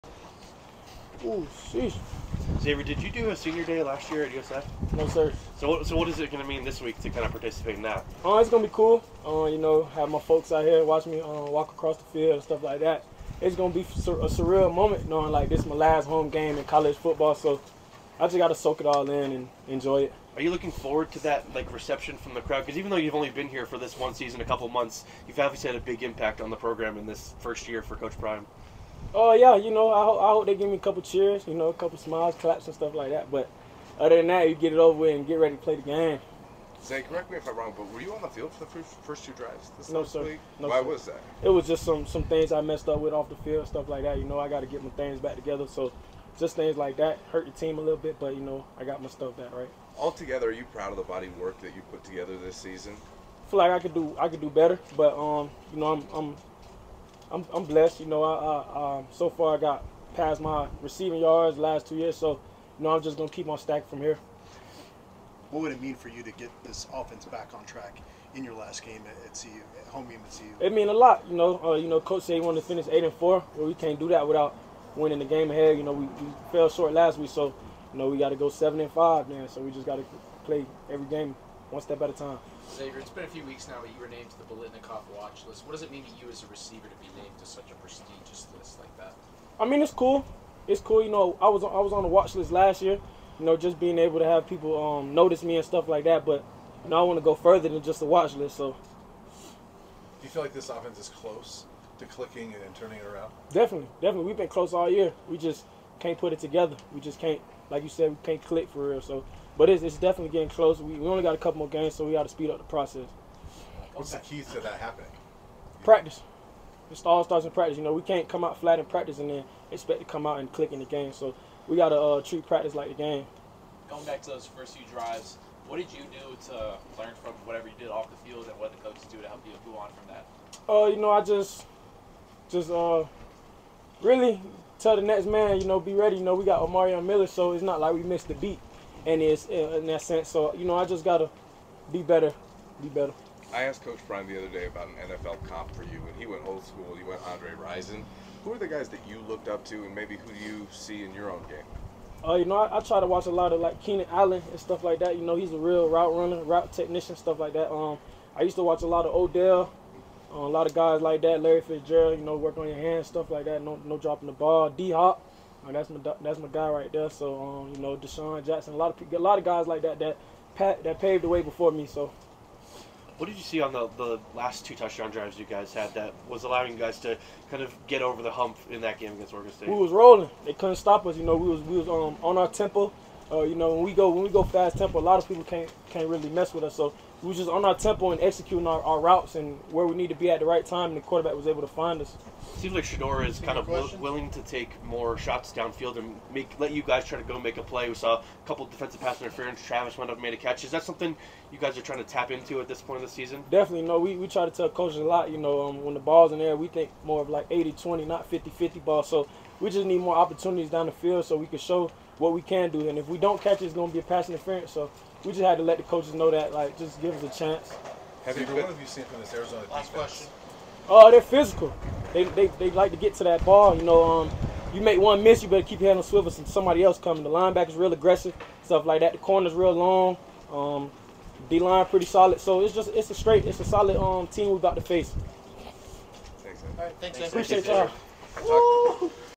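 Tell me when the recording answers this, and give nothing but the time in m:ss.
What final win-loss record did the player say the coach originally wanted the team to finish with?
1:12.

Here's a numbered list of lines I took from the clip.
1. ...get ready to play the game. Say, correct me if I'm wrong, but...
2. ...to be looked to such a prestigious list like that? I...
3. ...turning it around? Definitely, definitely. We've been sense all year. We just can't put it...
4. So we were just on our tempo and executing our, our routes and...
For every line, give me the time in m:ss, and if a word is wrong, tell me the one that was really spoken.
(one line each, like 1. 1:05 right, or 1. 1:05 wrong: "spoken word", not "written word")
1. 0:35 right
2. 1:26 wrong: "named", not "looked"
3. 1:42 wrong: "close", not "sense"
4. 3:06 right.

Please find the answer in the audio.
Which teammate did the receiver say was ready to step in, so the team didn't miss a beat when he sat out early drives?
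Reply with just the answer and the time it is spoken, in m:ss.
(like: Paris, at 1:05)
Omarion Miller, at 2:16.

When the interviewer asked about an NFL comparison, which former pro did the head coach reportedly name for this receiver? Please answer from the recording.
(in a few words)
Andre Rison.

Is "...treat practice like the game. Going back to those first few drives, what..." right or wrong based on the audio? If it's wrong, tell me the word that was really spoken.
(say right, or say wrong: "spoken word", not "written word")
right.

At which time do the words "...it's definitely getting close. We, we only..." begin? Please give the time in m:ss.
1:49.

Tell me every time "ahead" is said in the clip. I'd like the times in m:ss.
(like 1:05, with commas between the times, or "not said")
1:15.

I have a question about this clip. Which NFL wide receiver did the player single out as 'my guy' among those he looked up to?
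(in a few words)
D Hop.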